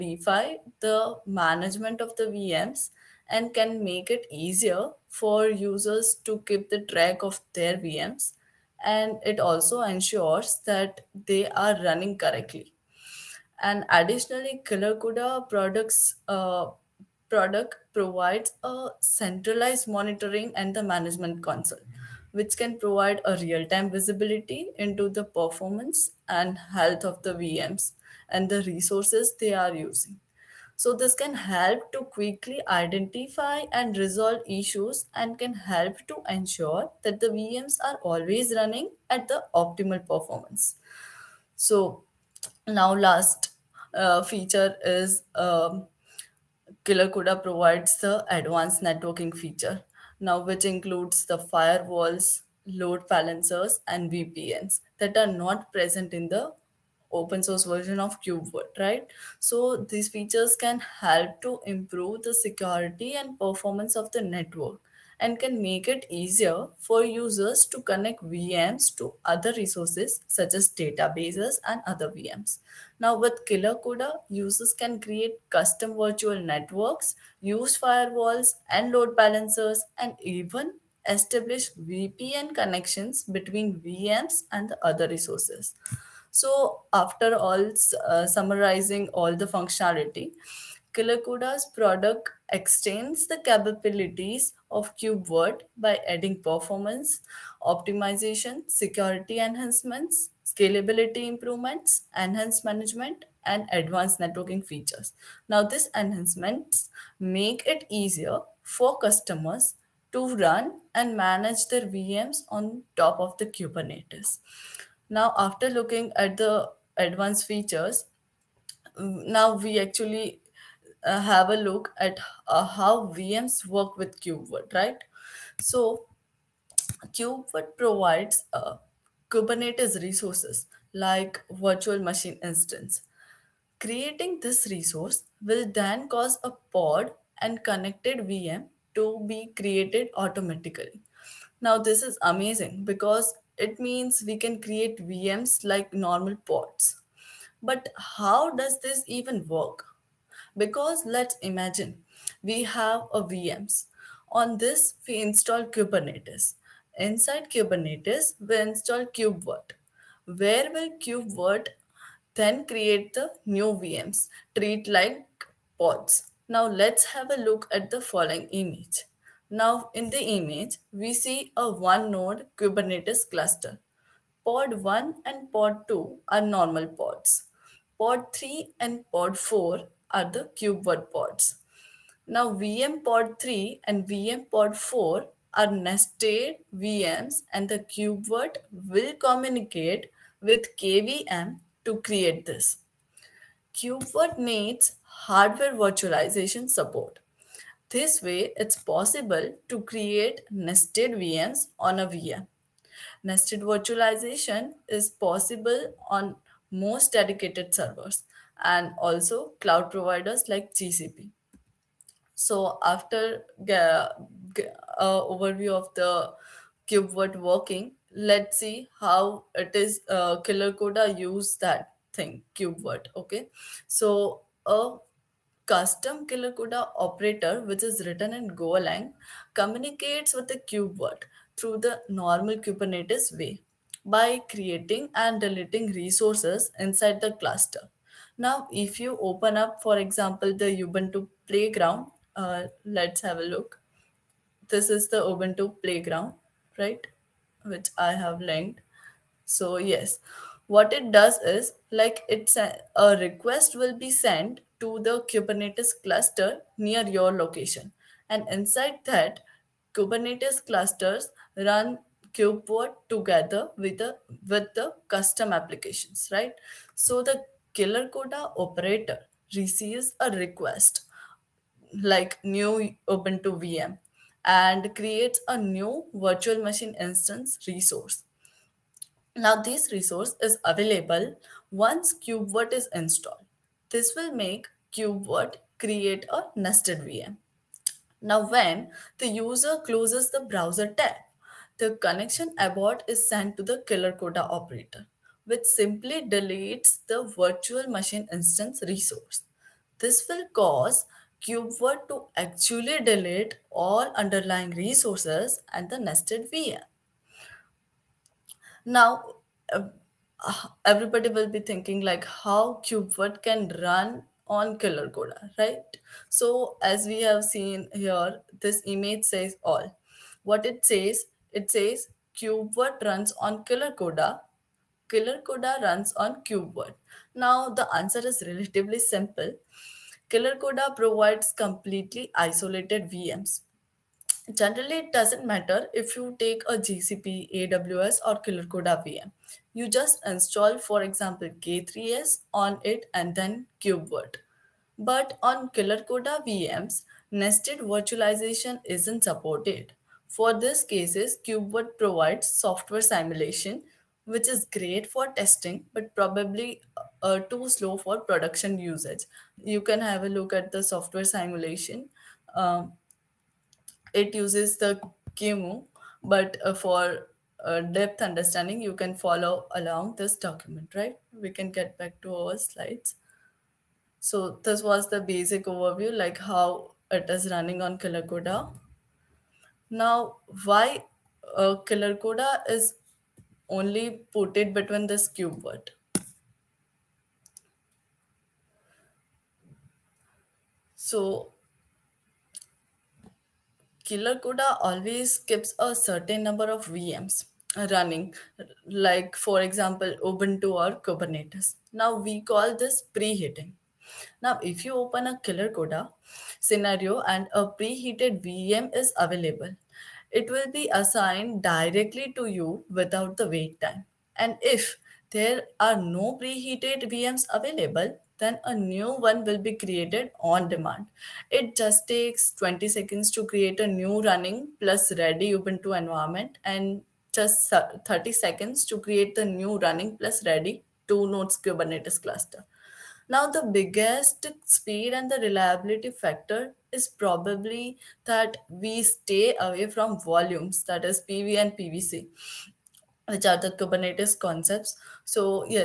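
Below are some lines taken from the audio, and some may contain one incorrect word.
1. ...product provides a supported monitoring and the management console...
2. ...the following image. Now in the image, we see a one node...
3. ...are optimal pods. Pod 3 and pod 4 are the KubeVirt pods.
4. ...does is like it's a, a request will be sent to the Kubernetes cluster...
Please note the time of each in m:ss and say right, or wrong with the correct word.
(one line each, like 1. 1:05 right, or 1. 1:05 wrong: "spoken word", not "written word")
1. 0:17 wrong: "centralized", not "supported"
2. 2:47 right
3. 2:56 wrong: "normal", not "optimal"
4. 4:11 right.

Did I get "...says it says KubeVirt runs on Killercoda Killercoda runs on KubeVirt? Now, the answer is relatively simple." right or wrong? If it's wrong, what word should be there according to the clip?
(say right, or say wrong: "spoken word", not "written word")
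right.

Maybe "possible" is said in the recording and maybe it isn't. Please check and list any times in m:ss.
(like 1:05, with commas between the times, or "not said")
3:18, 3:25.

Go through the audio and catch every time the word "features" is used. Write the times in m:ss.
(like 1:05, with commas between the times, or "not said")
0:44, 0:49, 1:00, 1:44, 1:57.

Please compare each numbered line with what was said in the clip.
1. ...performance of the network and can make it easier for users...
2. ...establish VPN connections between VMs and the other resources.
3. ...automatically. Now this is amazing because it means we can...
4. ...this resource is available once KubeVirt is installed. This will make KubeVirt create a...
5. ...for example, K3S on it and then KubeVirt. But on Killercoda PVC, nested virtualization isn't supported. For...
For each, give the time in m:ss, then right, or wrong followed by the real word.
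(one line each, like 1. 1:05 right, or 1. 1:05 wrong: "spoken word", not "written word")
1. 1:03 right
2. 1:21 right
3. 2:20 right
4. 4:39 right
5. 5:40 wrong: "VMs", not "PVC".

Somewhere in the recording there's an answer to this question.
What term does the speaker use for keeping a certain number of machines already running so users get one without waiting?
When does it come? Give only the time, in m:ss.
6:43.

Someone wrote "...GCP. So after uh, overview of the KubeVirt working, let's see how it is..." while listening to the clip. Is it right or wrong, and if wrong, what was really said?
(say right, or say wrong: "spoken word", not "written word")
right.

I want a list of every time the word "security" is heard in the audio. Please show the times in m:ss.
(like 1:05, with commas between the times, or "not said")
1:02, 1:38.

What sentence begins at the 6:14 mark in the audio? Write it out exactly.
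So this was the basic overview, like how it is running on Killercoda.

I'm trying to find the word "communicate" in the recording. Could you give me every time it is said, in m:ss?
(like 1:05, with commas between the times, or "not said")
3:09, 3:49.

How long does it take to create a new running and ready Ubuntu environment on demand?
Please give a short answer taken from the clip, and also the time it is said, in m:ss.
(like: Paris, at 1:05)
20 seconds, at 7:02.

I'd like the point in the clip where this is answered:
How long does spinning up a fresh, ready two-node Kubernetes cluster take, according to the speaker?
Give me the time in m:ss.
7:08.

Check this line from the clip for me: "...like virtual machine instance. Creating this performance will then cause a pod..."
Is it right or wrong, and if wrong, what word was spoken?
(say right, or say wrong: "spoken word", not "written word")
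wrong: "resource", not "performance".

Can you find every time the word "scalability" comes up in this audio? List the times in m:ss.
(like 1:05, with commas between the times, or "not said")
1:40.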